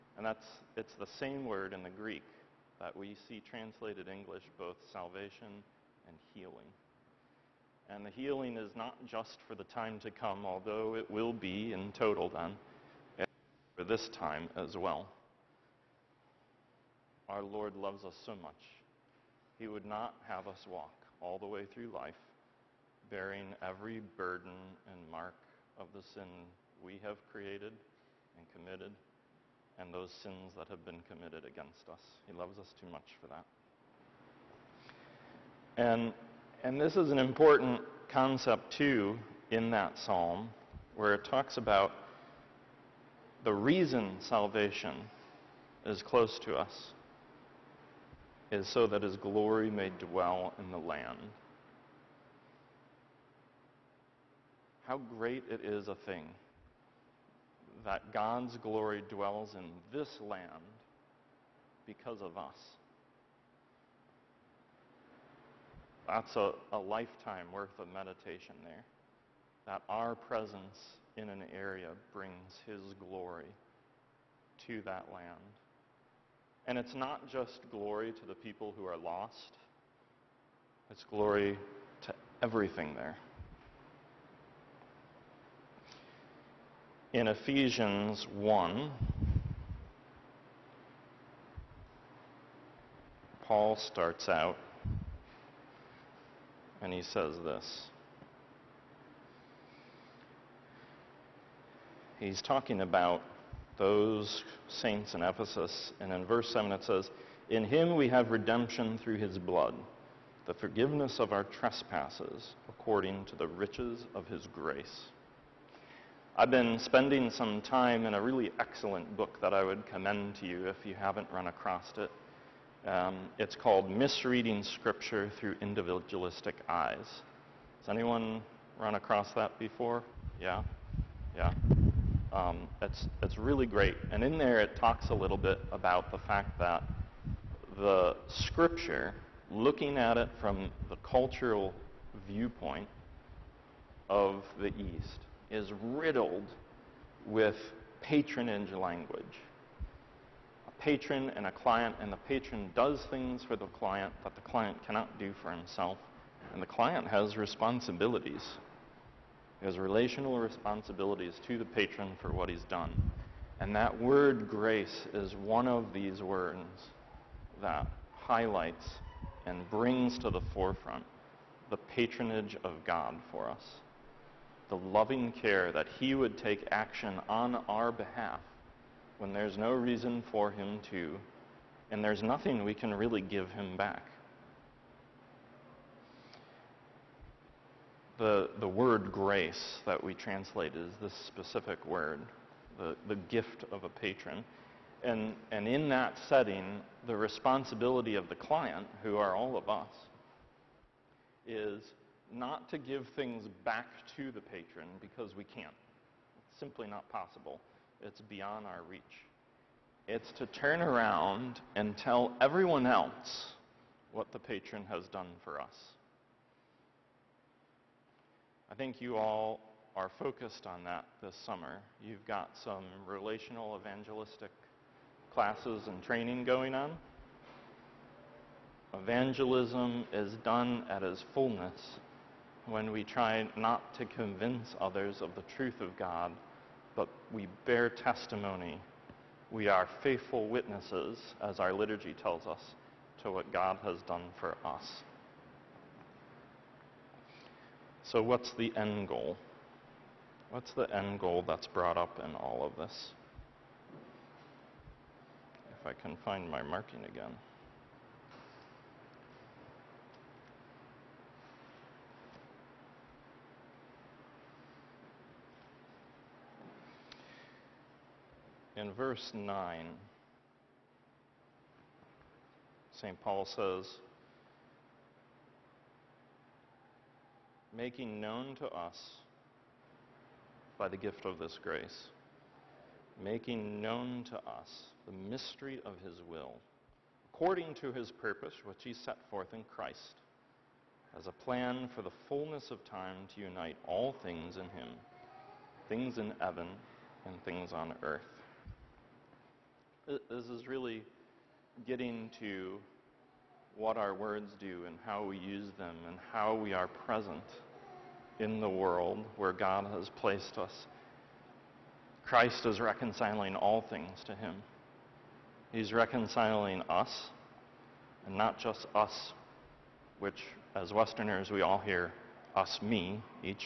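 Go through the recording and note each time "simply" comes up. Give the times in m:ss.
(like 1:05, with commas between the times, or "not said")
3:26.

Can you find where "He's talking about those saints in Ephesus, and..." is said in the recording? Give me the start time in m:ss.
1:42.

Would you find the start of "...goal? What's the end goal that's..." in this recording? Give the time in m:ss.
4:09.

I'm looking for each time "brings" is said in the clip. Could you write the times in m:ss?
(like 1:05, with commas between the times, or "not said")
1:12, 2:49.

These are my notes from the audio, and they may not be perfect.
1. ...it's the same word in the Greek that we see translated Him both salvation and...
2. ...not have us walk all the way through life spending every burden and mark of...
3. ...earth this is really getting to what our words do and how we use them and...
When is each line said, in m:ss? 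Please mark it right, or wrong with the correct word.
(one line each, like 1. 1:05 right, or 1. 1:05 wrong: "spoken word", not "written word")
1. 0:00 wrong: "English", not "Him"
2. 0:19 wrong: "bearing", not "spending"
3. 4:58 right.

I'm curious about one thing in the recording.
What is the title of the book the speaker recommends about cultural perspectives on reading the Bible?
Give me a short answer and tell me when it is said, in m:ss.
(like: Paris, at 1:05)
Misreading Scripture Through Individualistic Eyes, at 2:03.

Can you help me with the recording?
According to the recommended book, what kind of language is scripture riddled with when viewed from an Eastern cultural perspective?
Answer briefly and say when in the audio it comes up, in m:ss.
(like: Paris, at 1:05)
Patronage language, at 2:28.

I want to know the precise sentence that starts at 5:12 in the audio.
Christ is reconciling all things to Him.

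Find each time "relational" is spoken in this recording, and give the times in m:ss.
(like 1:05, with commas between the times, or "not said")
2:39, 3:43.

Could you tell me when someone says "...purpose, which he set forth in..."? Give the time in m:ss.
4:48.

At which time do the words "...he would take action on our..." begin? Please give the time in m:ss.
2:55.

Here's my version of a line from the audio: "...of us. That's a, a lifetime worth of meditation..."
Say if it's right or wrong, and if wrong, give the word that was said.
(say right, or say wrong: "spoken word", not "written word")
right.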